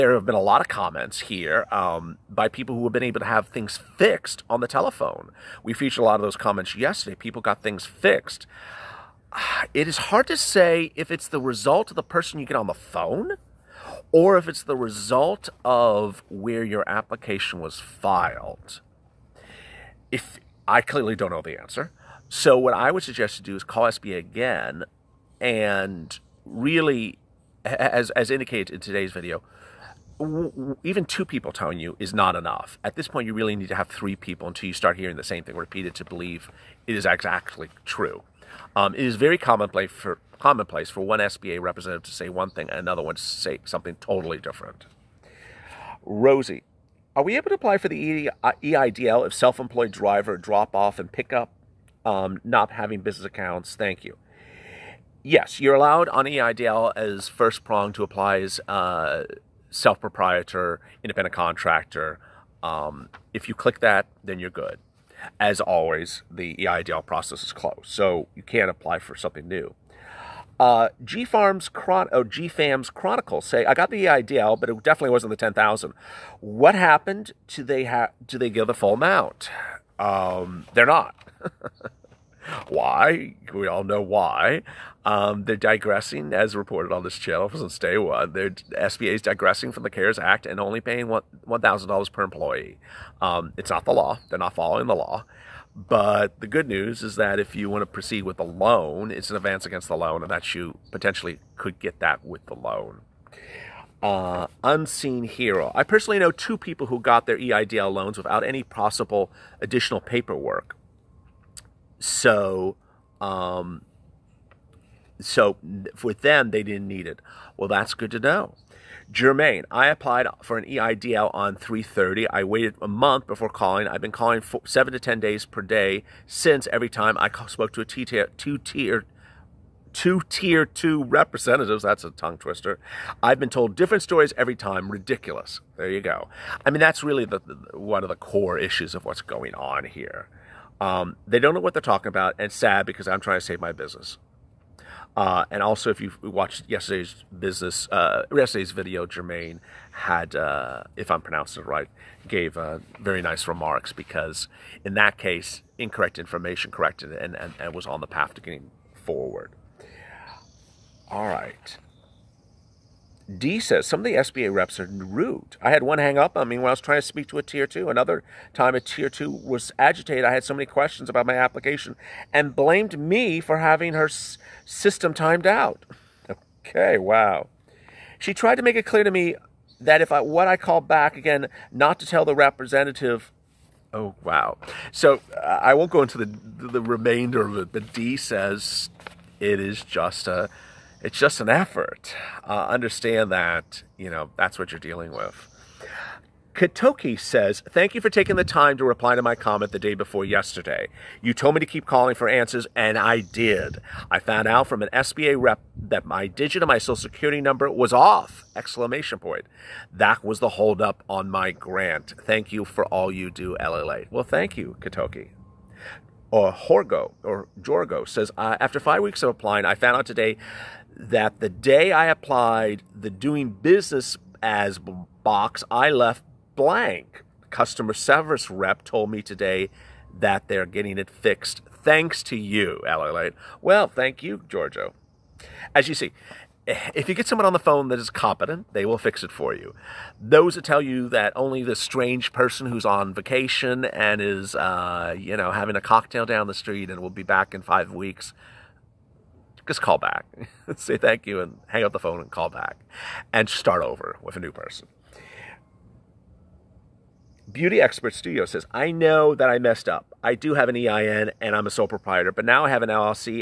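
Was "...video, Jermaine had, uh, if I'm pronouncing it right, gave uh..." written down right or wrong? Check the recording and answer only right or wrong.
right.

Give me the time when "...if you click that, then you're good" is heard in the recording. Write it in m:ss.
1:03.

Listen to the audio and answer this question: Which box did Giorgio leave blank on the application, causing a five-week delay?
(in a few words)
Doing business as.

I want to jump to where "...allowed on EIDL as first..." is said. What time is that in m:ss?
0:55.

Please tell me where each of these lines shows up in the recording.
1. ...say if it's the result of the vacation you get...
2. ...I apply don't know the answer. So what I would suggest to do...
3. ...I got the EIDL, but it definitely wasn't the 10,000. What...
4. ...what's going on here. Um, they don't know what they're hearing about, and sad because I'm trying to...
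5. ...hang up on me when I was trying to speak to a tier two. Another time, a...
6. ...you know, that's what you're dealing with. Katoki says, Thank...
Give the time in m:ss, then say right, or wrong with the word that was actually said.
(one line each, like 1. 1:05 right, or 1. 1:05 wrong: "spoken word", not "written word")
1. 0:10 wrong: "person", not "vacation"
2. 0:20 wrong: "clearly", not "apply"
3. 1:13 right
4. 2:19 wrong: "talking", not "hearing"
5. 2:45 right
6. 3:13 right.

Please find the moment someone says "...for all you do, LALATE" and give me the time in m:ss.
3:32.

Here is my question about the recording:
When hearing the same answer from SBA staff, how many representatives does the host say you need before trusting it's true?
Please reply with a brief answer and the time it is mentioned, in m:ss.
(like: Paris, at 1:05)
3, at 0:33.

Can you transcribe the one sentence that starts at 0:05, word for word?
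We featured a lot of those comments yesterday.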